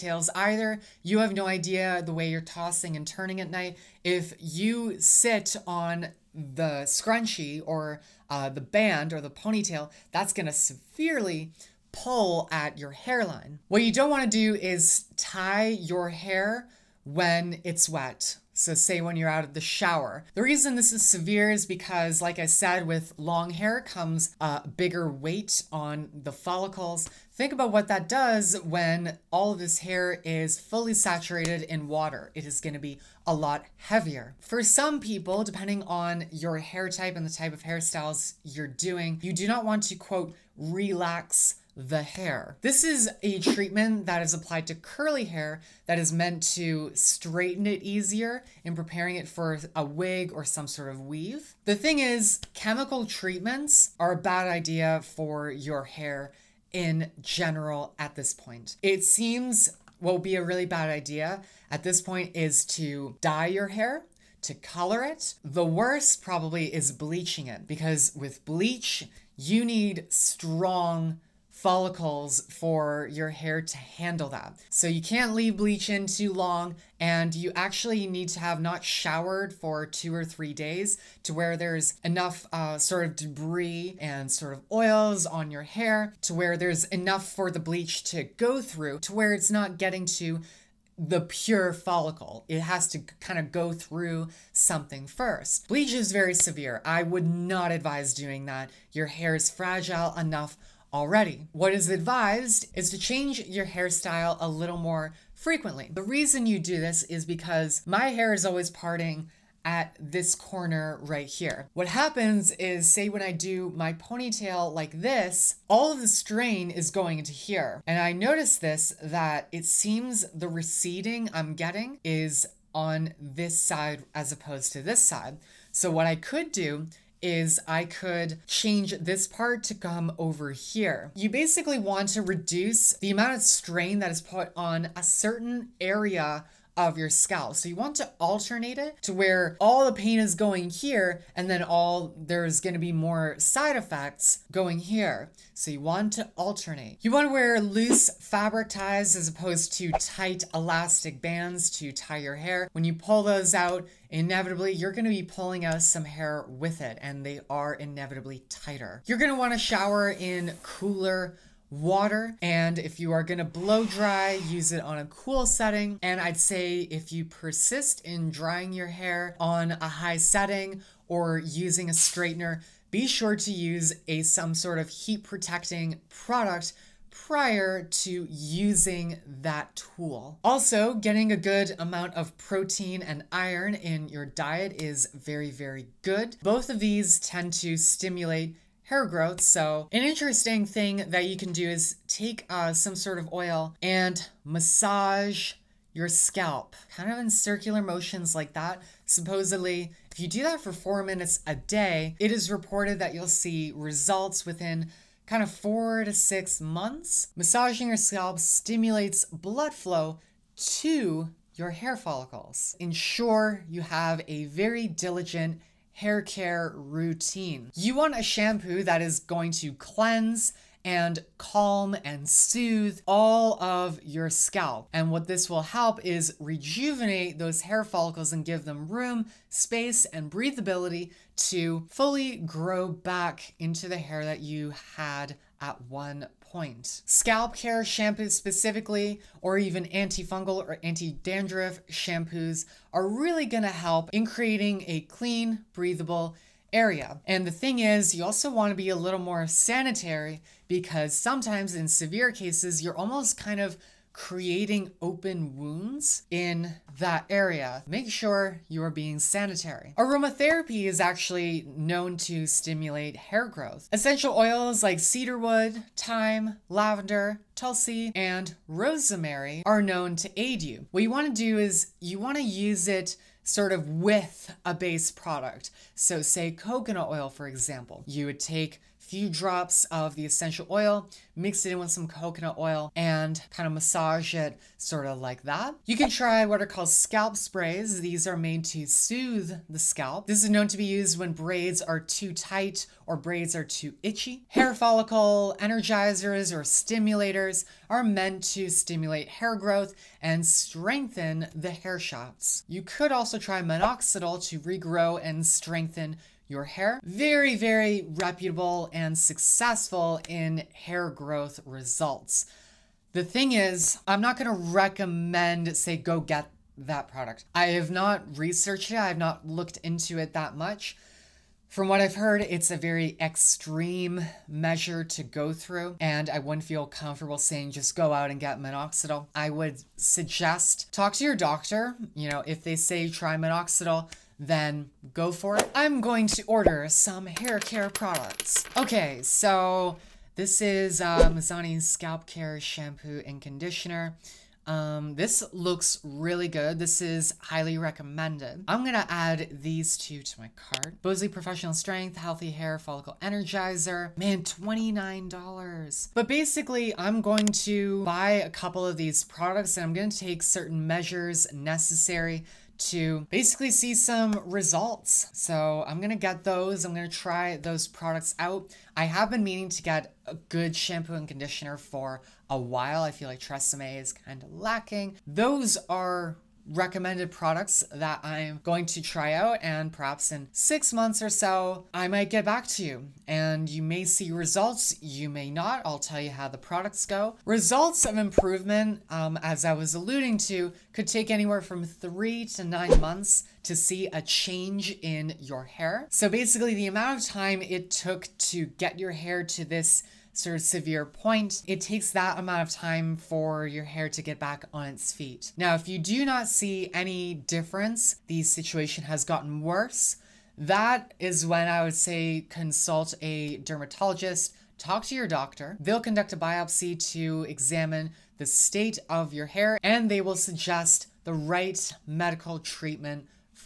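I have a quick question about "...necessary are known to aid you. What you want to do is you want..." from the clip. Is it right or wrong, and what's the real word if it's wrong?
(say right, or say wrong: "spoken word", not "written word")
wrong: "rosemary", not "necessary".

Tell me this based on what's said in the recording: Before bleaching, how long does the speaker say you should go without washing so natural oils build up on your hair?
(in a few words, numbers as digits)
2 or 3 days.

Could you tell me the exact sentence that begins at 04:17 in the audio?
Make sure you are being sanitary.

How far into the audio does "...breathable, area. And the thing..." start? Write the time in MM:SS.
04:05.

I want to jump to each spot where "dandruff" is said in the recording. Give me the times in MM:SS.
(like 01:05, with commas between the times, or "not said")
04:00.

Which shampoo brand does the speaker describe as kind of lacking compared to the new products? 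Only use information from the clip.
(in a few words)
Tresemme.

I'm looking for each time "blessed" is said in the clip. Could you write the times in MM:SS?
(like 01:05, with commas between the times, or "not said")
not said.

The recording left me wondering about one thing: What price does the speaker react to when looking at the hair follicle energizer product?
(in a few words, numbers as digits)
$29.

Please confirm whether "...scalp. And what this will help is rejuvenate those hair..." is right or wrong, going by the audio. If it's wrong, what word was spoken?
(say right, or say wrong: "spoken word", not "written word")
right.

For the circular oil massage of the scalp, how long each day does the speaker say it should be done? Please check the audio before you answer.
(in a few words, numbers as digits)
4 minutes.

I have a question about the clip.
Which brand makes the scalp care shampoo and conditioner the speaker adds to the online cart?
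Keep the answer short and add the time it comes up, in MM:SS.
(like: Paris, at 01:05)
Mizani, at 05:41.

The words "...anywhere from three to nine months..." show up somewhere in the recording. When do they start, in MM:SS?
06:31.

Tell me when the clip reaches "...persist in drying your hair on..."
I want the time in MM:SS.
02:47.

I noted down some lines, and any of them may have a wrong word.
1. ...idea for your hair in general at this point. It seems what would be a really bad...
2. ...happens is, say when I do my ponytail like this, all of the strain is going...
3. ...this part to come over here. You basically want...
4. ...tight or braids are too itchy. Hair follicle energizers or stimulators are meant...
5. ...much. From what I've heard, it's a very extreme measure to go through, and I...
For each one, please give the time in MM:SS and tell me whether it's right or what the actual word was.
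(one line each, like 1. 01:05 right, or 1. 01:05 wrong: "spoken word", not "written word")
1. 00:54 right
2. 01:51 right
3. 02:08 right
4. 04:52 right
5. 05:20 right.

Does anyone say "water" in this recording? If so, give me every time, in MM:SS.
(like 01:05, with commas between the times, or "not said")
00:31, 02:41.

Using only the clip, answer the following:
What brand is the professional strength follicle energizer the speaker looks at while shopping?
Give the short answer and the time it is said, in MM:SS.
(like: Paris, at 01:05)
Bosley, at 05:51.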